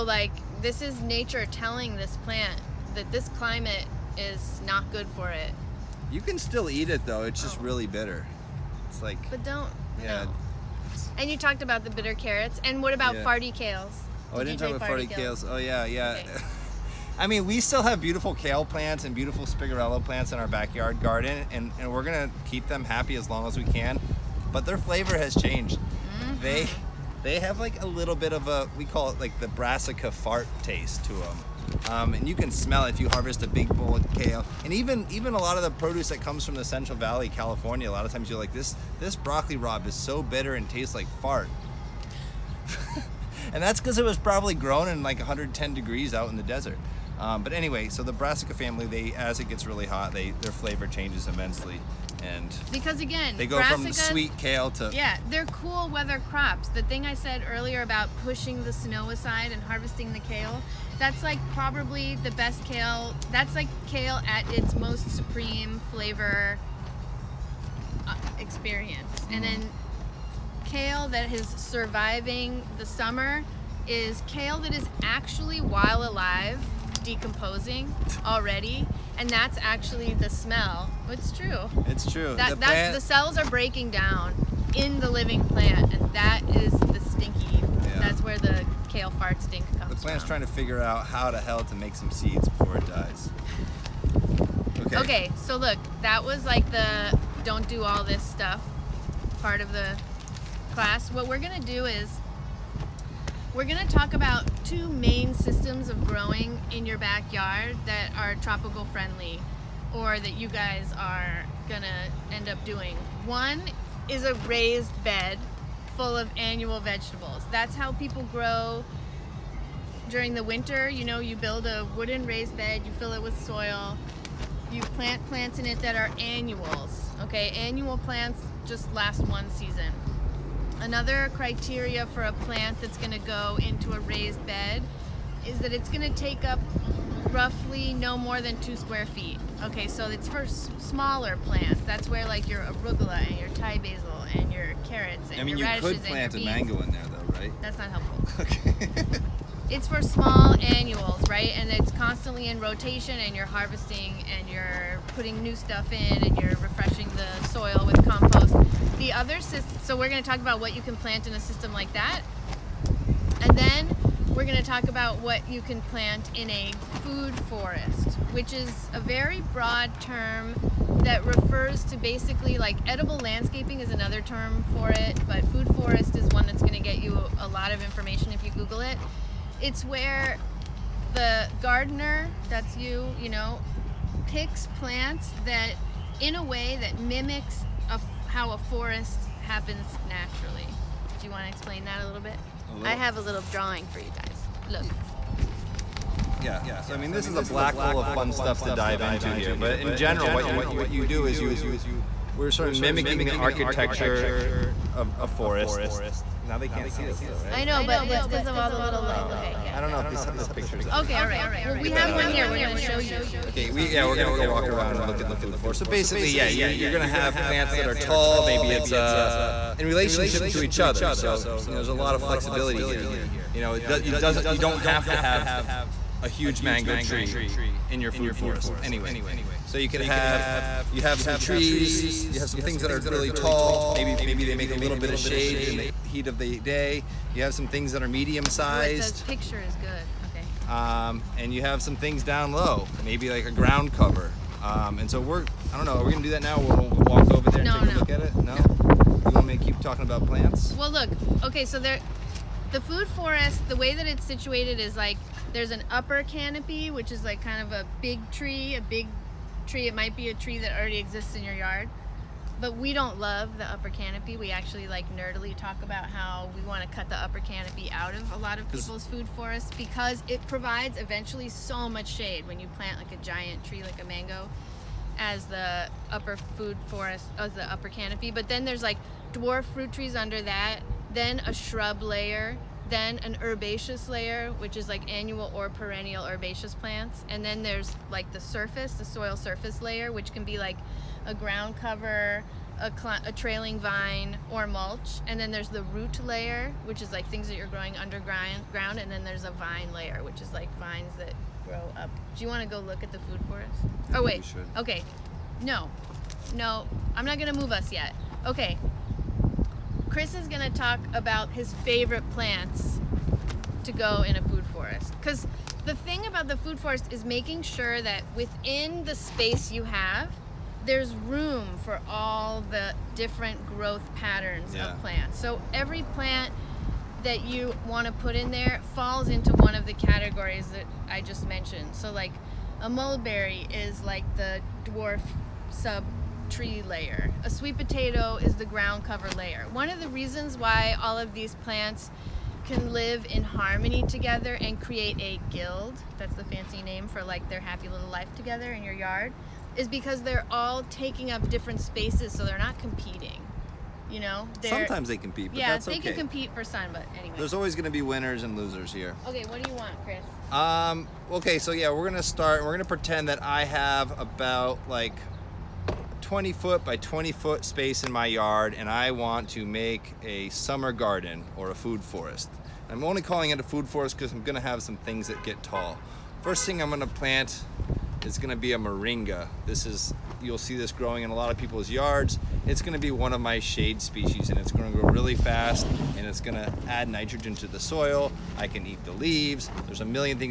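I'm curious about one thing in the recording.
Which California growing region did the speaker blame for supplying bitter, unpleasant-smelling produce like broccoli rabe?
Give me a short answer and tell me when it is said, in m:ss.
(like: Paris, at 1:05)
Central Valley, at 0:36.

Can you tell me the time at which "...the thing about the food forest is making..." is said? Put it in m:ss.
5:15.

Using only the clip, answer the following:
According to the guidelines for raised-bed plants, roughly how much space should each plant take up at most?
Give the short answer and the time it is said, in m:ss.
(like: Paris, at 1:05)
2 square feet, at 2:18.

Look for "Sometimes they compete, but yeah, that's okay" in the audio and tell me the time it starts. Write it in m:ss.
5:54.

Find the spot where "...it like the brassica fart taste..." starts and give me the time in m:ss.
0:29.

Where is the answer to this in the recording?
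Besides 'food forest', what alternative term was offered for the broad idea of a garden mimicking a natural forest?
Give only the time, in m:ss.
2:52.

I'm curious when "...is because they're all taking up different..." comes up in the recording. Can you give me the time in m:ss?
5:49.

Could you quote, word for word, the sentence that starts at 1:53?
One is a raised bed full of annual vegetables.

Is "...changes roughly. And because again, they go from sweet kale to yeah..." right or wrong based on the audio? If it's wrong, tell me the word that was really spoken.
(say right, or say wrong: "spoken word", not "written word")
wrong: "immensely", not "roughly".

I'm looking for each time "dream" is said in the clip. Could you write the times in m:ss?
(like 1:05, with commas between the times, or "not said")
not said.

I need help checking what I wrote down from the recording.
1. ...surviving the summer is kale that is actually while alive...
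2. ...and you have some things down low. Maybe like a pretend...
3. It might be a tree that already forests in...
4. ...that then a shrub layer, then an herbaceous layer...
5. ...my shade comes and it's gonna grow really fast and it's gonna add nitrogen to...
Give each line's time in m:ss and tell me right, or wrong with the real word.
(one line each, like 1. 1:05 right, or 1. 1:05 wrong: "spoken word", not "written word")
1. 1:11 right
2. 4:01 wrong: "ground", not "pretend"
3. 4:19 wrong: "exists", not "forests"
4. 4:40 right
5. 6:23 wrong: "species", not "comes".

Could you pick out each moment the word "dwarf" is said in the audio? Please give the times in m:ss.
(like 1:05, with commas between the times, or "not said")
4:39, 5:34.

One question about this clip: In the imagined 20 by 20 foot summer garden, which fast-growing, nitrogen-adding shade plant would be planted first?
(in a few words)
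moringa.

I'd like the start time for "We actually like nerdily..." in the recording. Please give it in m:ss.
4:24.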